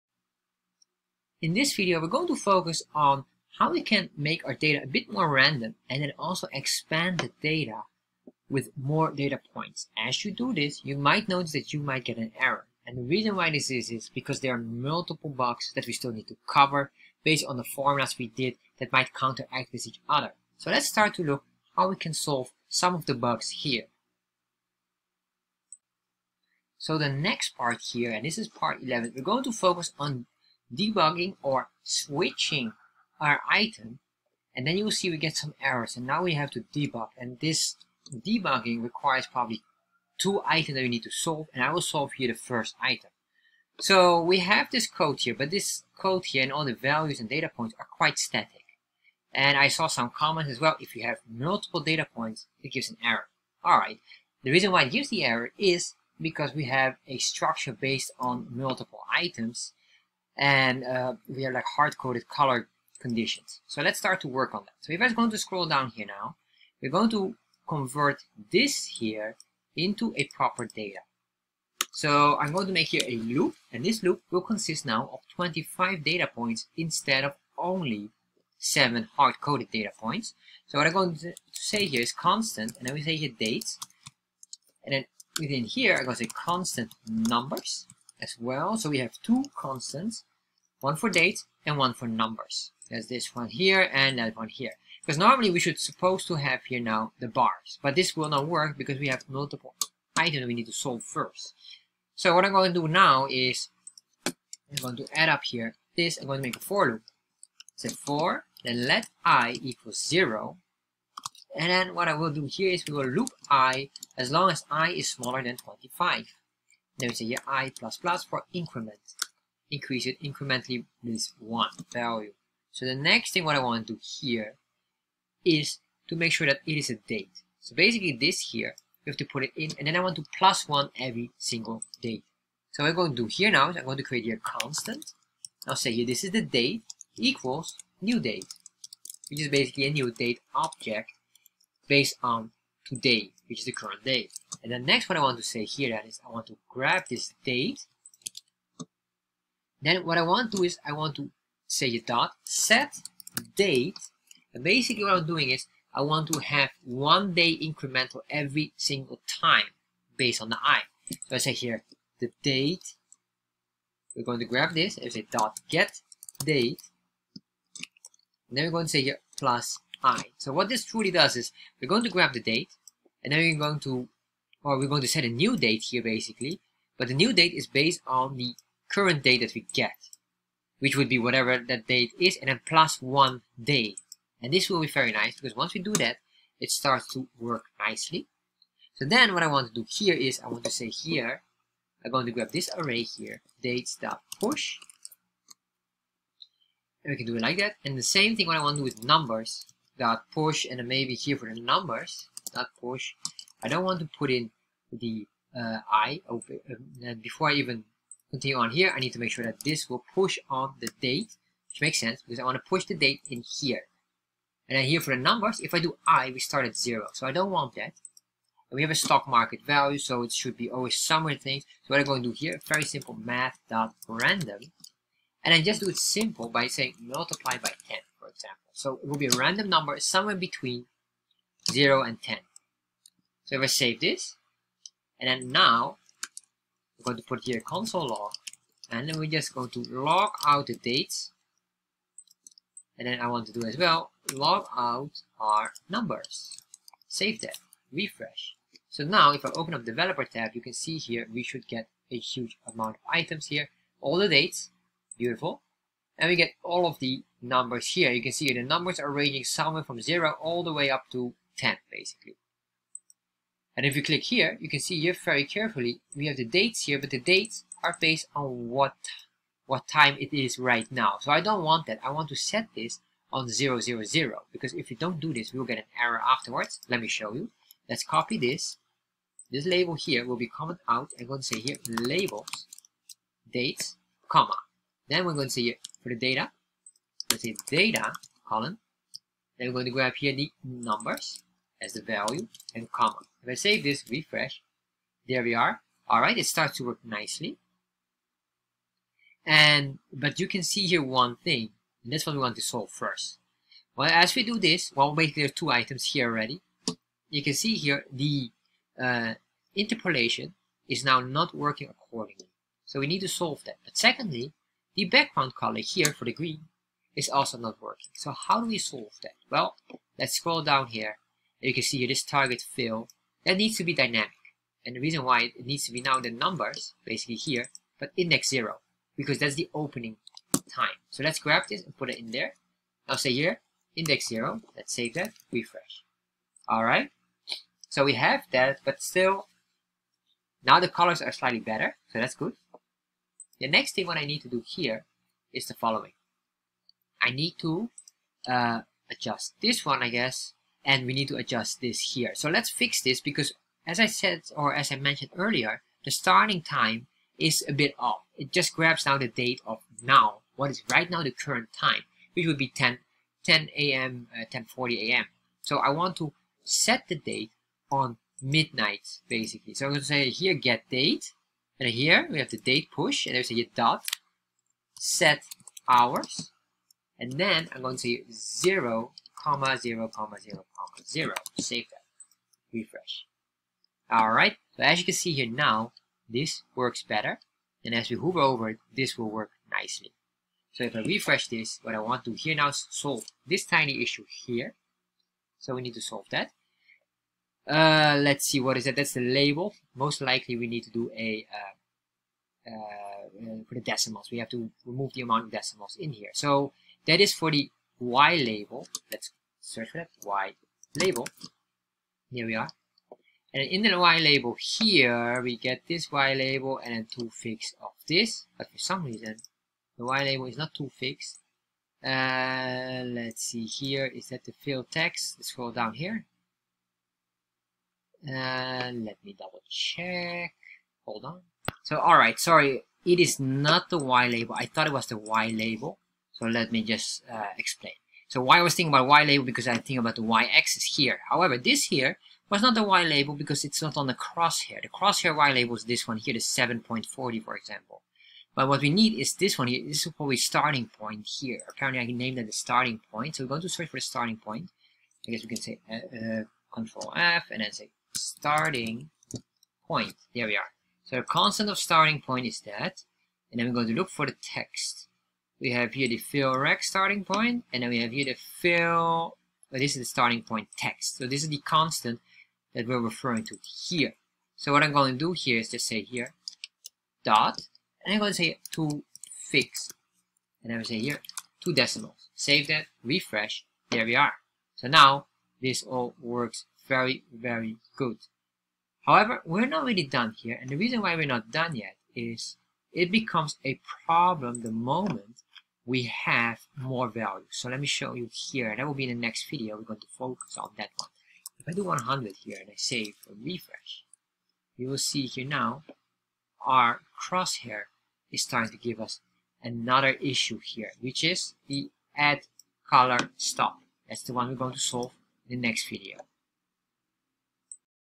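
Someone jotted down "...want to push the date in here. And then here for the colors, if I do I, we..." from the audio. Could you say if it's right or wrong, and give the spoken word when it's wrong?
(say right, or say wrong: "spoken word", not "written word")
wrong: "numbers", not "colors".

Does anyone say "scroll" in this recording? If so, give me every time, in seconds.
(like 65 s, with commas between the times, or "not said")
65 s, 320 s, 425 s.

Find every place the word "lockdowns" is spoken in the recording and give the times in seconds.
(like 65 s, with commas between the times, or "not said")
not said.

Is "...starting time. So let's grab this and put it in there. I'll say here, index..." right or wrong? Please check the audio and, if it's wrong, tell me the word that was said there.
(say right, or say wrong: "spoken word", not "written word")
wrong: "opening", not "starting".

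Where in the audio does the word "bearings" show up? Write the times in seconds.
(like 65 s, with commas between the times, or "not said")
not said.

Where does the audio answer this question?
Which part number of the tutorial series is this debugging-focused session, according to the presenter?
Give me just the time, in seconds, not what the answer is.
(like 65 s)
28 s.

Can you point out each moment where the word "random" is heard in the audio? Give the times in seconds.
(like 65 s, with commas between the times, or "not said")
5 s, 224 s, 229 s.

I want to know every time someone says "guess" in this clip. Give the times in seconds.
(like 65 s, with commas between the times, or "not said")
350 s, 455 s.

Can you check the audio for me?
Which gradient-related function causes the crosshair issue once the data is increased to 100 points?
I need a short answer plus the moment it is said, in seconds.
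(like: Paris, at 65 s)
add color stop, at 512 s.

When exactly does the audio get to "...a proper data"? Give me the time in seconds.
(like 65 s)
70 s.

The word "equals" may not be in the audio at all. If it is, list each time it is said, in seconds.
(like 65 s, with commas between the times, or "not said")
109 s, 137 s.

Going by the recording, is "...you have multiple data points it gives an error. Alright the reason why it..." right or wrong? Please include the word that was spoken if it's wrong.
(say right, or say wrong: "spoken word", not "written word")
right.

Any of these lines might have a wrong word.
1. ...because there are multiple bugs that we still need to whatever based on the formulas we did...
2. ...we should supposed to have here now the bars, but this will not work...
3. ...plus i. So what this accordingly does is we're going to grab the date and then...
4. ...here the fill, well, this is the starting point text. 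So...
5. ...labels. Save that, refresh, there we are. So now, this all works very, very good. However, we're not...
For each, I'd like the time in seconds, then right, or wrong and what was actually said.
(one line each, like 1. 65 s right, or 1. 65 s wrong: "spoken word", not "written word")
1. 14 s wrong: "cover", not "whatever"
2. 95 s right
3. 169 s wrong: "truly", not "accordingly"
4. 468 s right
5. 481 s wrong: "decimals", not "labels".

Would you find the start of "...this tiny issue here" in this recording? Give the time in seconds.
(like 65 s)
393 s.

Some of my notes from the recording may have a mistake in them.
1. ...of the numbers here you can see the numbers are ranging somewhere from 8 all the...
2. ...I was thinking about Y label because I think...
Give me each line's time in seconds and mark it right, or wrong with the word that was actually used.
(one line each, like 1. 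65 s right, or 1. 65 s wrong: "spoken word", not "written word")
1. 256 s wrong: "0", not "8"
2. 438 s right.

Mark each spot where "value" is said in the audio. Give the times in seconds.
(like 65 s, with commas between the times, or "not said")
46 s, 121 s, 219 s, 292 s, 497 s.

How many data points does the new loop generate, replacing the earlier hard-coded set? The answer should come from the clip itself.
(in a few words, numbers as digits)
25.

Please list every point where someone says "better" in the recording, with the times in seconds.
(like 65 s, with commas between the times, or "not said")
341 s, 387 s.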